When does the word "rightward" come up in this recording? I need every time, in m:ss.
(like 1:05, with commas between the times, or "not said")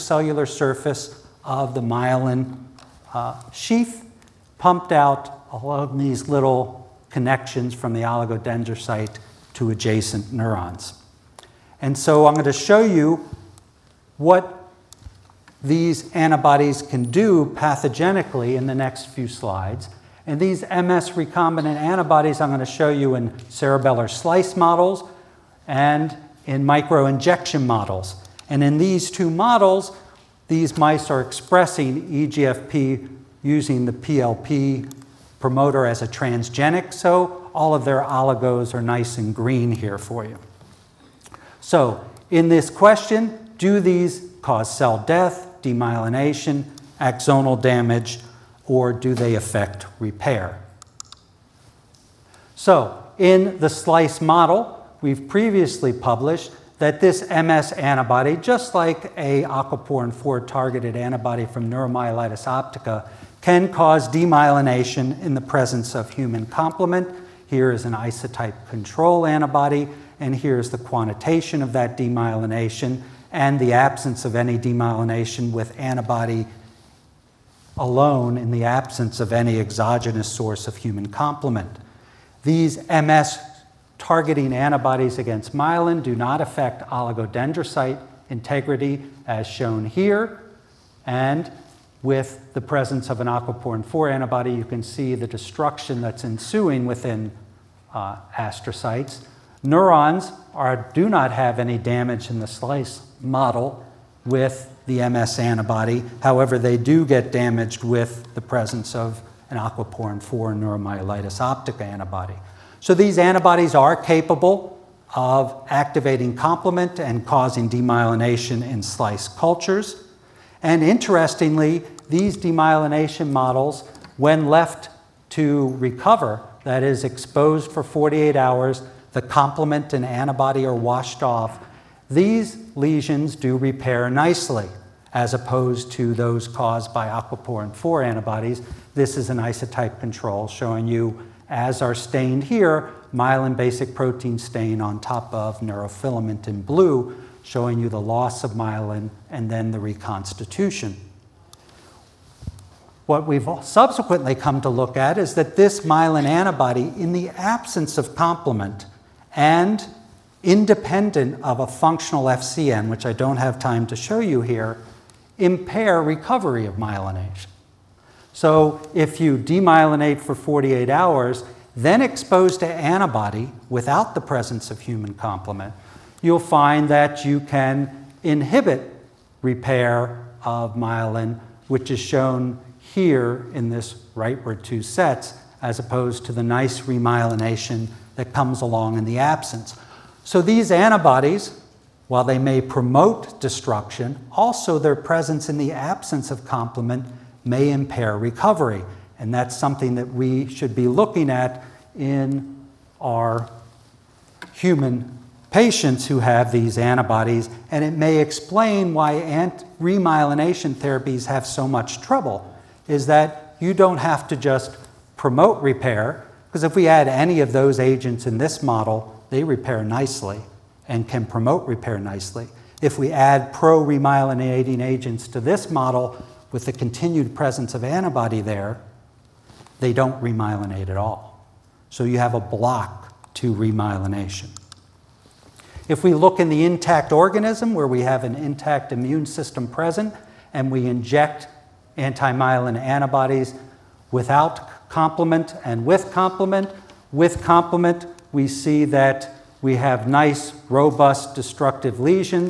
3:04.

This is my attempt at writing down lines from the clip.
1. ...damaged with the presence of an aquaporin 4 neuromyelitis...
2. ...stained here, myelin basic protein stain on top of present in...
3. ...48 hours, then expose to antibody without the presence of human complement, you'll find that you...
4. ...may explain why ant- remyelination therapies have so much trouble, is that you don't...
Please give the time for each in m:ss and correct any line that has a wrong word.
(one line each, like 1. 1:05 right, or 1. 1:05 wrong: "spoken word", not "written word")
1. 1:47 right
2. 2:21 wrong: "neurofilament", not "present"
3. 2:50 right
4. 3:27 right.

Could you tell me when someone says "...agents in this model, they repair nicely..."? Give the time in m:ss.
3:37.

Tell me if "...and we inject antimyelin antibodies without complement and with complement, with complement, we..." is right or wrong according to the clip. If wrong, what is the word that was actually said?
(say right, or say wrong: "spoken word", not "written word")
right.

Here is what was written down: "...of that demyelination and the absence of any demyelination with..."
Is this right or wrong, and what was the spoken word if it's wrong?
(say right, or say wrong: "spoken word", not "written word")
right.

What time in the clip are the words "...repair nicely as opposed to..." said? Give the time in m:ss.
2:13.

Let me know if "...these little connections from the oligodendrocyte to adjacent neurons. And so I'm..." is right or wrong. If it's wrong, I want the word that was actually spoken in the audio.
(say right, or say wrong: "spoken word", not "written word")
right.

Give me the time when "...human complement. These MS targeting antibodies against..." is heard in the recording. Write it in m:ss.
1:20.